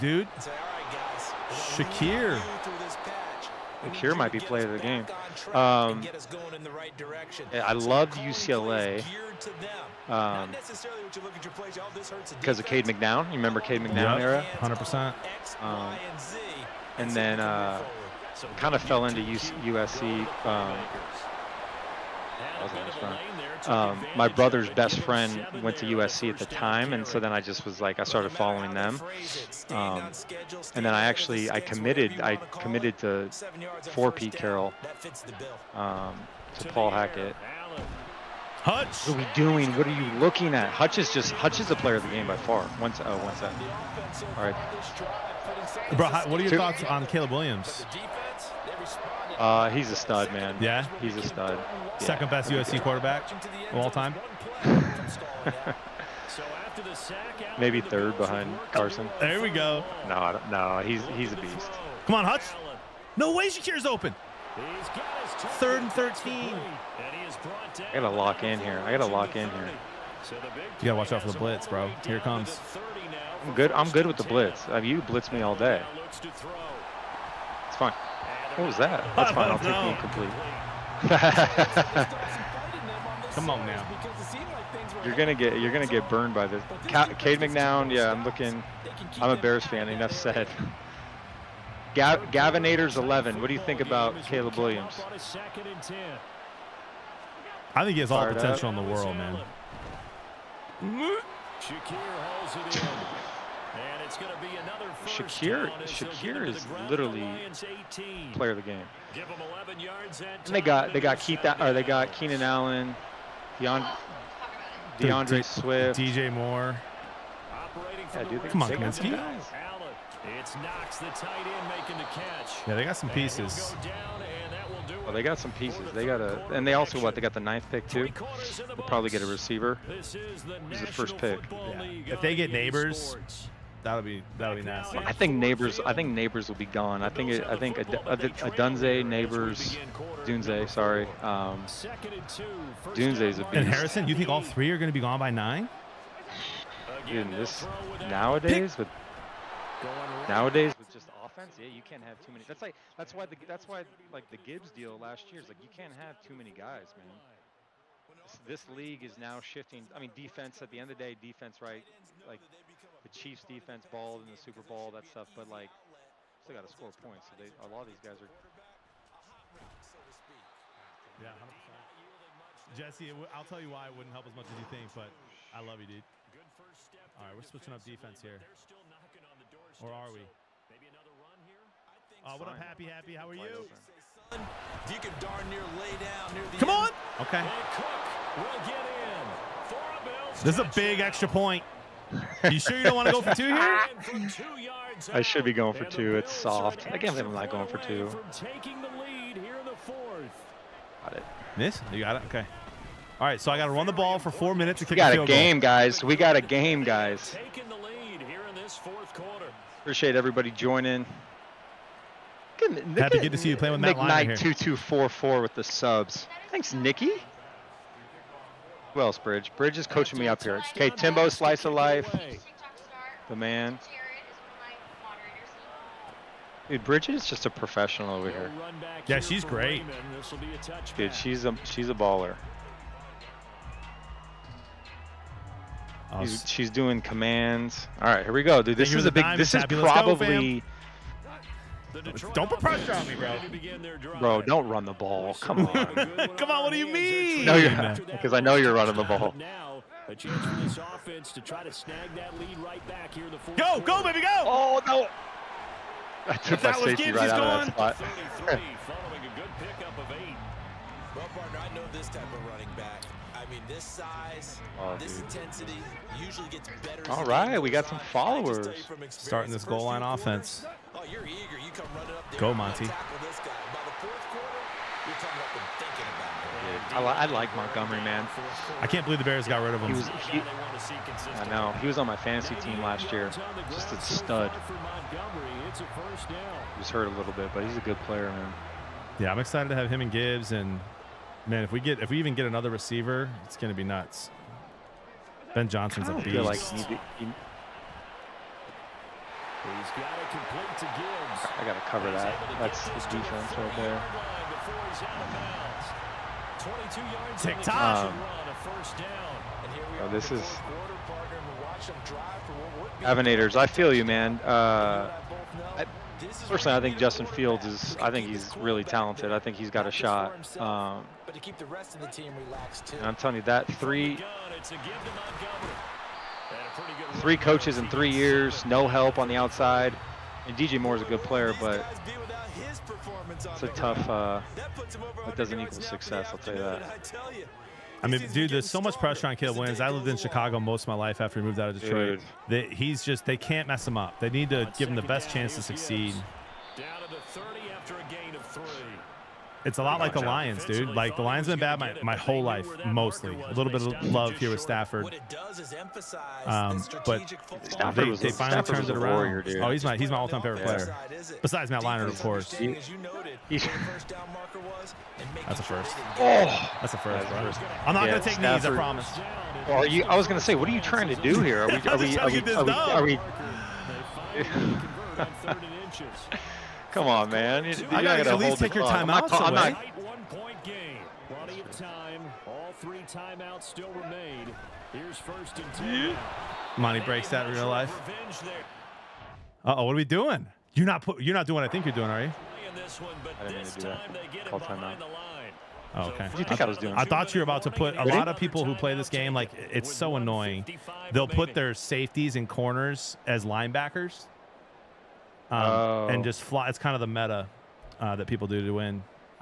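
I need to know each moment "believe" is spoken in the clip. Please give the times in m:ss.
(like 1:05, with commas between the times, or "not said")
3:17, 4:39.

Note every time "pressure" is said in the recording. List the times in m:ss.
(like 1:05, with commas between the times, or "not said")
4:02, 5:38.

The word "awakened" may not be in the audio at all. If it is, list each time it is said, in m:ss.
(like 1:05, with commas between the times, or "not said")
not said.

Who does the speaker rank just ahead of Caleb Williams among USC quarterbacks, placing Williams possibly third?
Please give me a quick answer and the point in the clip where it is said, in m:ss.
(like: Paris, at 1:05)
Carson, at 0:58.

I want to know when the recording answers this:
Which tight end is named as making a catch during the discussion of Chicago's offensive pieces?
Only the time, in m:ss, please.
2:00.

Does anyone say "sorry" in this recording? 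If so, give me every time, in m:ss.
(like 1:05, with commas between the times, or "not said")
2:20.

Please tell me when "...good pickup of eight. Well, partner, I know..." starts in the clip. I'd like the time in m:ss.
4:19.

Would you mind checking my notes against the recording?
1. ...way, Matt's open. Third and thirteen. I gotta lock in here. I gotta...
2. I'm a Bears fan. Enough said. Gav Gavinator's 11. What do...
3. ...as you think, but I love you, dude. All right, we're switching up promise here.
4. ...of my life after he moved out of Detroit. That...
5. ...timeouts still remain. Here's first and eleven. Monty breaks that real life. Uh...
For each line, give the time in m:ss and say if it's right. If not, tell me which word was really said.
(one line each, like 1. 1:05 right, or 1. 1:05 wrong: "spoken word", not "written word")
1. 1:03 wrong: "Shakir", not "Matt"
2. 1:29 right
3. 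2:54 wrong: "defense", not "promise"
4. 5:40 right
5. 6:23 wrong: "ten", not "eleven".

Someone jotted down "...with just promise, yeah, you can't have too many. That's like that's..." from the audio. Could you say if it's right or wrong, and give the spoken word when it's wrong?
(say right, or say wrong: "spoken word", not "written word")
wrong: "offense", not "promise".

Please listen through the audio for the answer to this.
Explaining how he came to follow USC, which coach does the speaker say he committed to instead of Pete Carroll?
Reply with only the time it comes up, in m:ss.
0:36.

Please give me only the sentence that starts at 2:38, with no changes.
This, this league is now shifting.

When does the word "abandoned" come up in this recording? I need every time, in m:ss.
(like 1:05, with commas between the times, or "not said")
not said.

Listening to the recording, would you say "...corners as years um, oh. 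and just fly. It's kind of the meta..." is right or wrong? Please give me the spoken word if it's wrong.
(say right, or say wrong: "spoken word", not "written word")
wrong: "linebackers", not "years".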